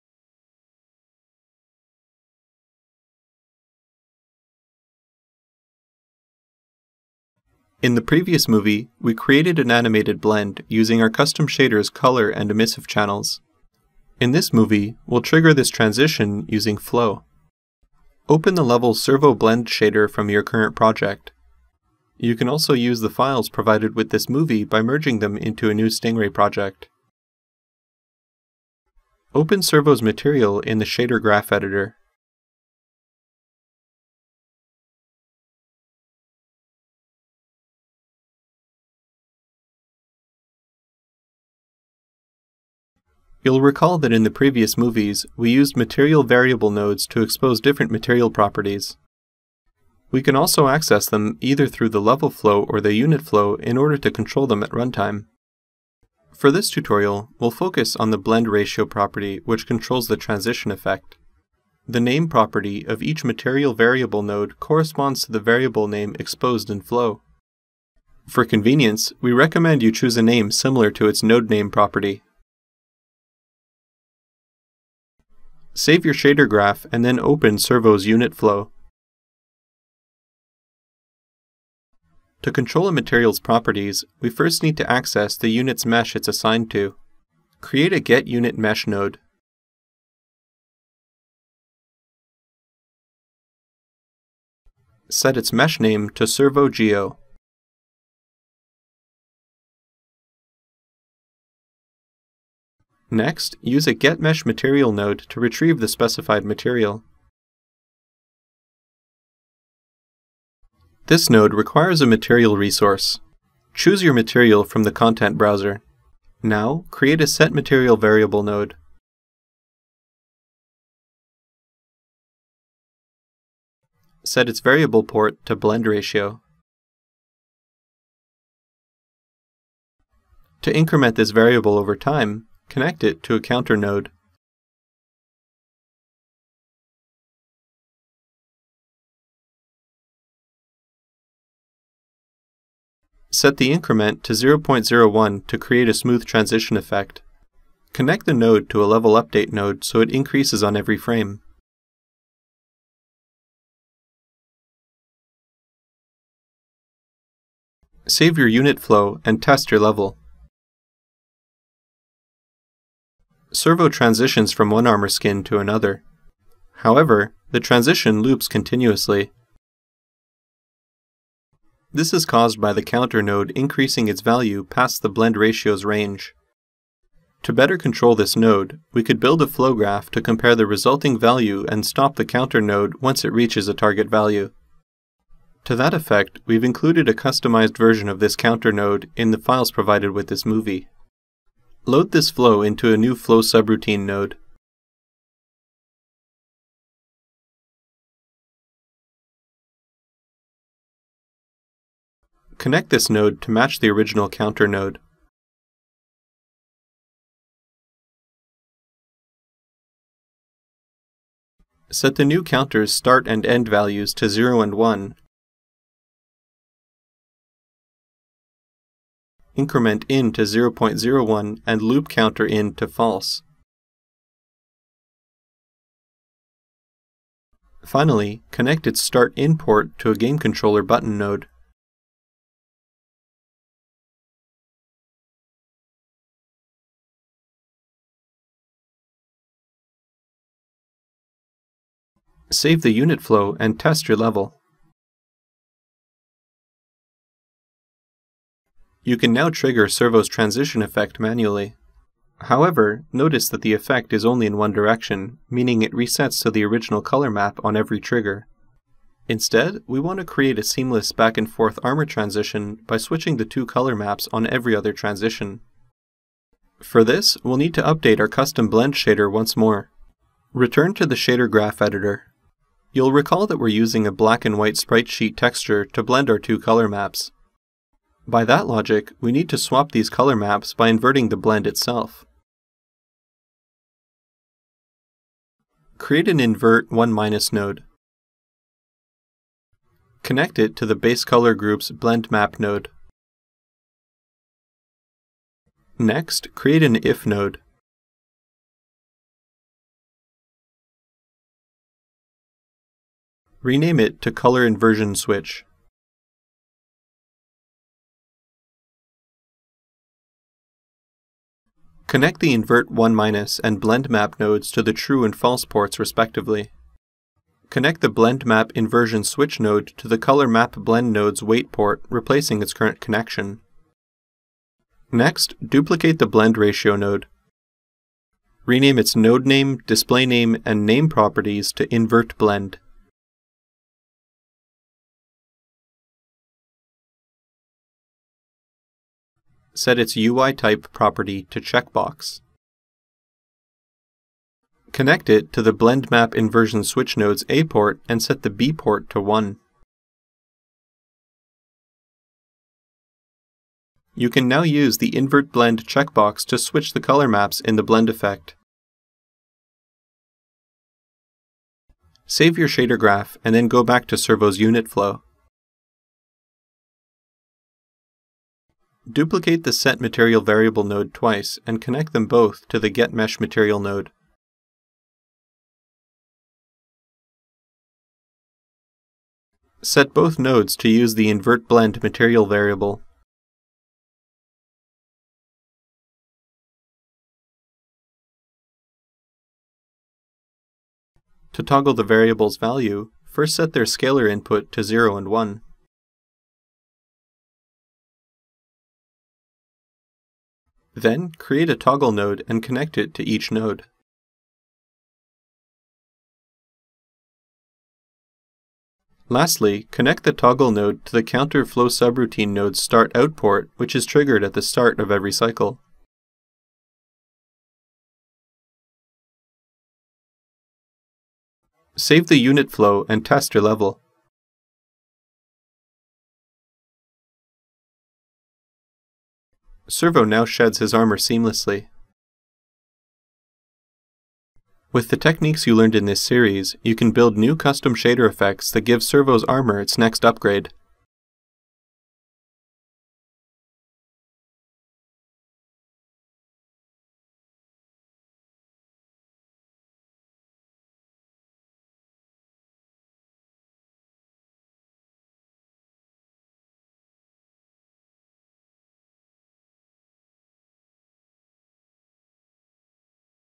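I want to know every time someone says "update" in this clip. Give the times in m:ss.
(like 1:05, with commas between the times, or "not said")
2:29, 4:27.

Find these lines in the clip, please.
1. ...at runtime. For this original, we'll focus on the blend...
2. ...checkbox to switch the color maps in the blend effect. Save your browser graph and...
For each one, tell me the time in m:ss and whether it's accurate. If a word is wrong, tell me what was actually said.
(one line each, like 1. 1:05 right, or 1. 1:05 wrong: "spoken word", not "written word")
1. 0:54 wrong: "tutorial", not "original"
2. 5:55 wrong: "shader", not "browser".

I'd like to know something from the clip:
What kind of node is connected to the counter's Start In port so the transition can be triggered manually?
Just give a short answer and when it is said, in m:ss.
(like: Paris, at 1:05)
Game Controller button, at 3:50.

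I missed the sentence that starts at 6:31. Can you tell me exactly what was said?
To toggle the variable's value, first set their scalar input to 0 and 1.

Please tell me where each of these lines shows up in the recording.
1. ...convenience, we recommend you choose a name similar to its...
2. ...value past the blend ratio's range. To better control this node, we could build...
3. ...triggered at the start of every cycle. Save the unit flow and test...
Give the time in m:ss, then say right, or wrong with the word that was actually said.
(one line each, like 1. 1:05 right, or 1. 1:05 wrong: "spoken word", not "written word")
1. 1:08 right
2. 2:54 right
3. 6:54 right.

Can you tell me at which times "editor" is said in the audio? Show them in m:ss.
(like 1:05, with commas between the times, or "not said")
0:31, 4:31.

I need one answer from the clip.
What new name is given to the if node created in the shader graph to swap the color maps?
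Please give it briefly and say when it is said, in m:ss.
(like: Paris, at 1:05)
color inversion switch, at 5:04.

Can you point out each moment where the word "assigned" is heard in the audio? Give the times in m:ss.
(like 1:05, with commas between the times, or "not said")
1:26.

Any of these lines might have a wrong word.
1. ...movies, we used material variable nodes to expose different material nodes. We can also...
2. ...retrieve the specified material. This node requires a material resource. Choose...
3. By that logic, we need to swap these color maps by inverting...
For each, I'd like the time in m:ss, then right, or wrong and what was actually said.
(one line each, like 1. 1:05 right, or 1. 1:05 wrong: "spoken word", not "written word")
1. 0:44 wrong: "properties", not "nodes"
2. 1:45 right
3. 4:38 right.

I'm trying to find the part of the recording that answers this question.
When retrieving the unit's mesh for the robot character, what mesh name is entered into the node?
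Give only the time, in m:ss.
1:36.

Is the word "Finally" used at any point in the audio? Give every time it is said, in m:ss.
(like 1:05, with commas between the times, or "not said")
3:47.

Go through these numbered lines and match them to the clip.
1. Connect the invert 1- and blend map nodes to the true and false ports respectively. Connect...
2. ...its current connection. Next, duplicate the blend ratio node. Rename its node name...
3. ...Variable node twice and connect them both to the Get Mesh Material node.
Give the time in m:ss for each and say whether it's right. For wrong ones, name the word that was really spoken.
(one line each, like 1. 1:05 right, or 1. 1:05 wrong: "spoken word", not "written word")
1. 5:12 right
2. 5:22 right
3. 6:10 right.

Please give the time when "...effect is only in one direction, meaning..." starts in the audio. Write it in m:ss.
4:13.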